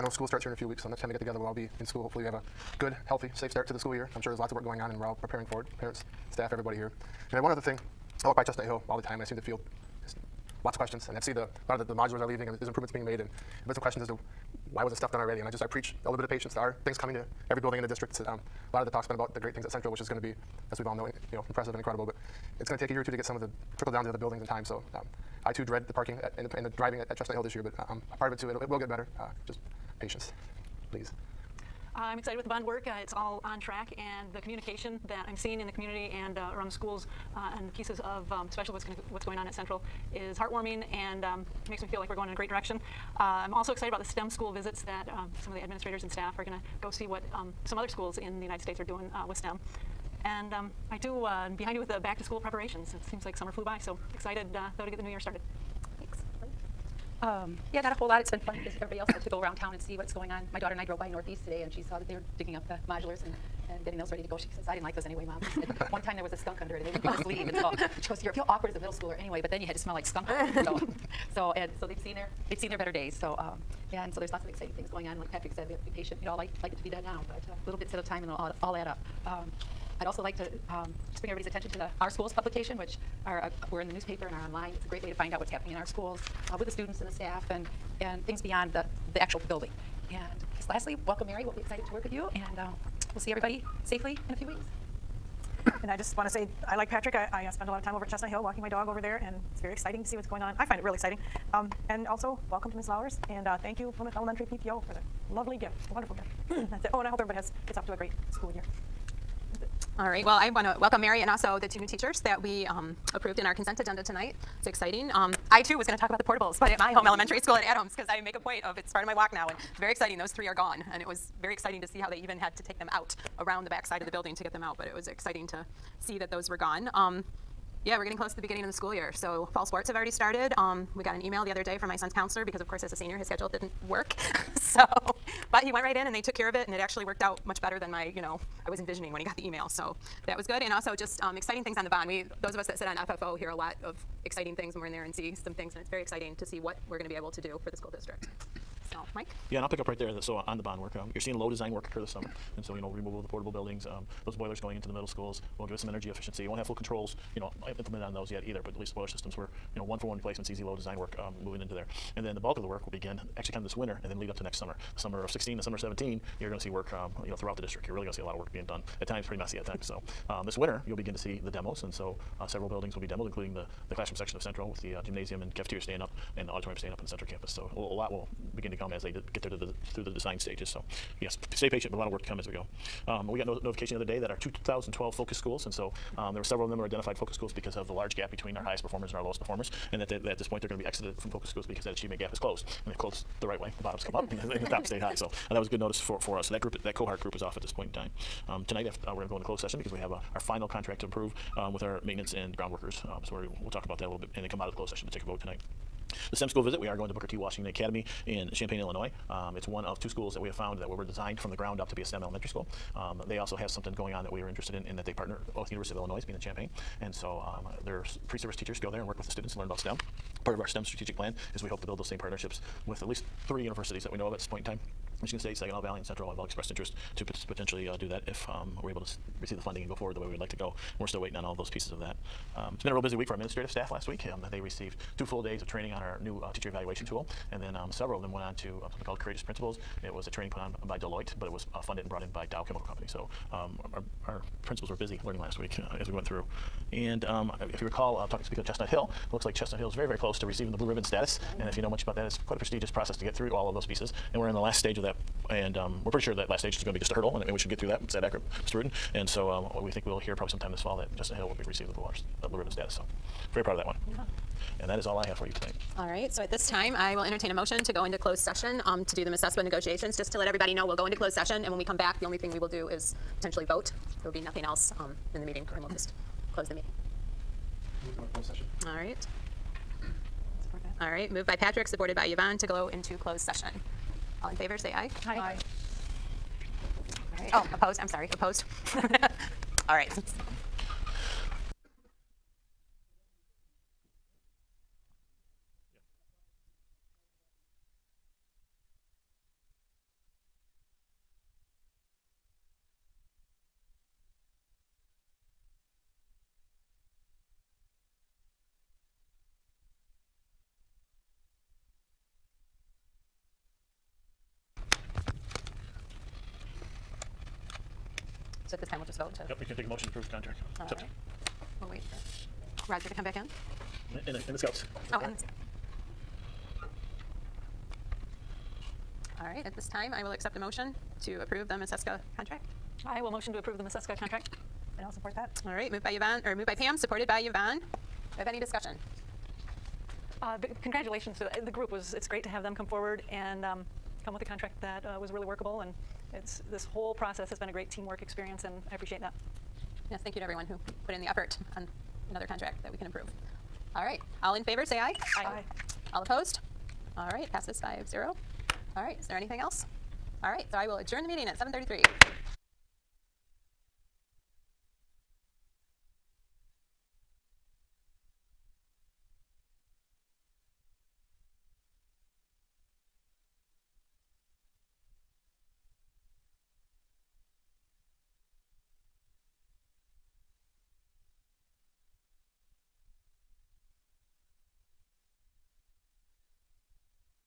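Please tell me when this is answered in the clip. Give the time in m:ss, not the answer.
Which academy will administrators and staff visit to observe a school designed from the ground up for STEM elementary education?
3:27.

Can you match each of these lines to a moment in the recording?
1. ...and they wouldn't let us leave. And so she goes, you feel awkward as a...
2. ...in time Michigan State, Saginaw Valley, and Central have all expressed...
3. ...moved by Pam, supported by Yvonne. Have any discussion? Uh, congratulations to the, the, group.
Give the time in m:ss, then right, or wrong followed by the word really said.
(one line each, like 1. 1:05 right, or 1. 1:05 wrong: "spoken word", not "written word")
1. 1:06 right
2. 3:44 right
3. 5:36 right.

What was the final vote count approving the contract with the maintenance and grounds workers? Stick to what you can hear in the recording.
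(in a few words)
5-0.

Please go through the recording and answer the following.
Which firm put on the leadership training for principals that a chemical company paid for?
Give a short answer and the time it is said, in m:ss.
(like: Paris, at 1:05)
Deloitte, at 4:00.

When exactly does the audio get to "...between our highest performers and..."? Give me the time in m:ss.
3:08.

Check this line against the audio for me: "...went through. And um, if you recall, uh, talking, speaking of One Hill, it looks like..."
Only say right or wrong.
wrong.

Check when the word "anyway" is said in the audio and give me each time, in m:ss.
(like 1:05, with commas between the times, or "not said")
1:05, 1:09.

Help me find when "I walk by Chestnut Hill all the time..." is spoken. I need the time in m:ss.
0:08.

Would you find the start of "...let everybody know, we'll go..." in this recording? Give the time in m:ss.
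4:30.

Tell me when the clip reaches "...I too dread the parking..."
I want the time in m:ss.
0:25.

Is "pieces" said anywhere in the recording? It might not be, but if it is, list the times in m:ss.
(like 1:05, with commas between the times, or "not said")
0:37, 3:51, 4:13.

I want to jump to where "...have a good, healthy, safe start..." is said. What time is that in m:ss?
0:02.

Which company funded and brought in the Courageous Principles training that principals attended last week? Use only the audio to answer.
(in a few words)
Dow Chemical Company.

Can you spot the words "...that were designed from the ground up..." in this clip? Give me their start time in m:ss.
3:30.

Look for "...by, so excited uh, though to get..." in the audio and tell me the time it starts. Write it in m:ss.
0:53.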